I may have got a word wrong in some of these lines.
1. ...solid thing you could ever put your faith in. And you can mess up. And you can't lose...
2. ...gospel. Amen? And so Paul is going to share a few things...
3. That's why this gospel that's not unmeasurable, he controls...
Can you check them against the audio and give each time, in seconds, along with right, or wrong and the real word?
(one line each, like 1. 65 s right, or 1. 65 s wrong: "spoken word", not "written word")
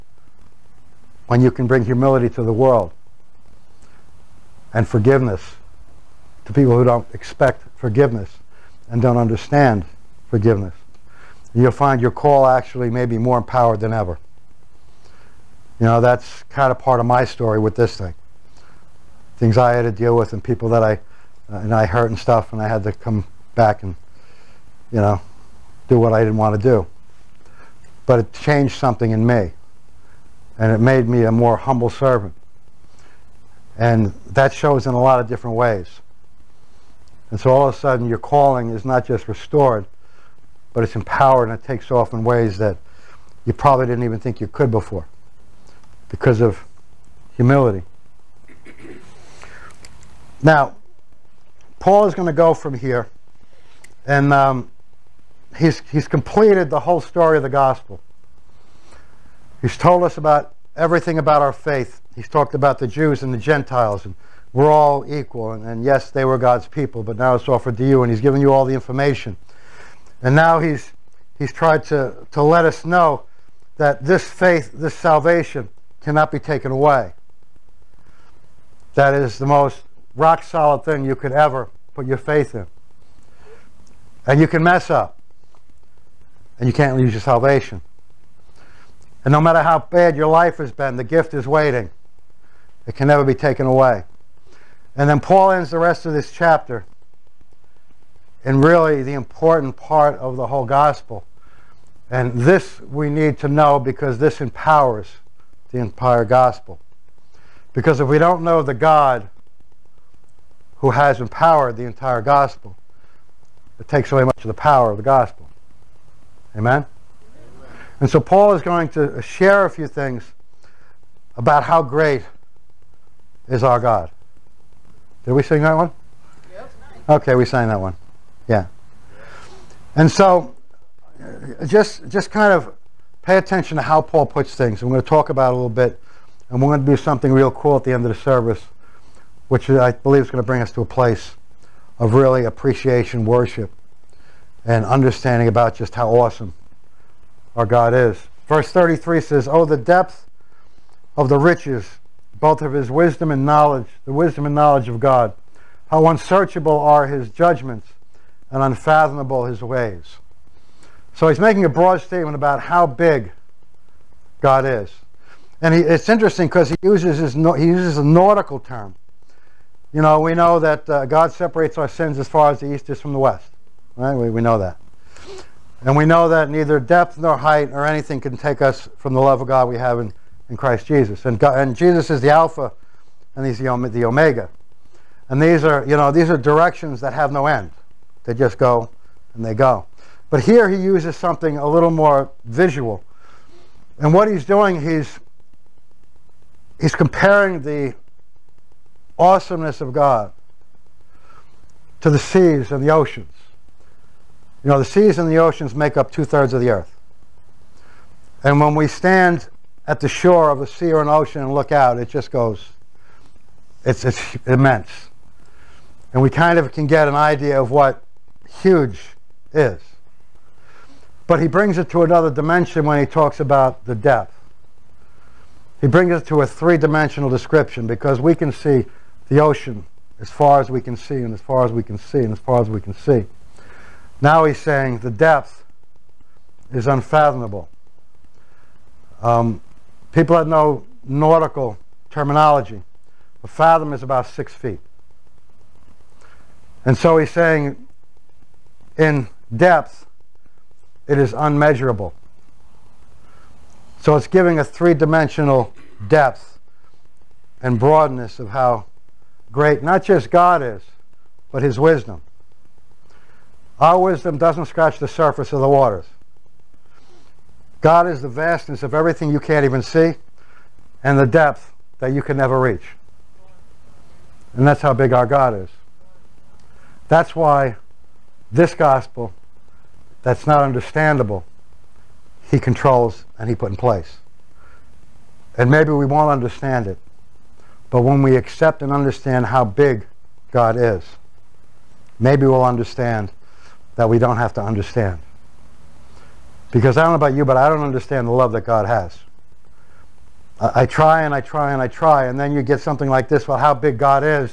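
1. 80 s right
2. 115 s right
3. 277 s wrong: "understandable", not "unmeasurable".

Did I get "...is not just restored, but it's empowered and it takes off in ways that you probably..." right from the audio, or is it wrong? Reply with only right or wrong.
right.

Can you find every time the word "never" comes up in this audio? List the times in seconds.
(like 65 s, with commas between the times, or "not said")
93 s, 272 s.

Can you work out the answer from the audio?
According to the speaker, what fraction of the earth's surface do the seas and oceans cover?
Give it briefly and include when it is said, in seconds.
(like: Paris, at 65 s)
two-thirds, at 206 s.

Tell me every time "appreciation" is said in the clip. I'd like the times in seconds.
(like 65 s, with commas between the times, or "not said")
142 s.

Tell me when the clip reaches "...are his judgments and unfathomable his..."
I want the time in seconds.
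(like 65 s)
156 s.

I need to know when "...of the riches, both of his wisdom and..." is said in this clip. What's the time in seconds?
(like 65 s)
151 s.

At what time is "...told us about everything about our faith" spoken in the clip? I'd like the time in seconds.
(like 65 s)
59 s.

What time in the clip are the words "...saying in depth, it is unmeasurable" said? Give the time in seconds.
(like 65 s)
247 s.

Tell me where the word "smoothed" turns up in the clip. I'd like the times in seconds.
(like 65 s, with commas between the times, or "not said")
not said.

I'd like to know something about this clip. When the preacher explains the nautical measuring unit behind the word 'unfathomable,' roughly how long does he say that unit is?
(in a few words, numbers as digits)
about 6 feet.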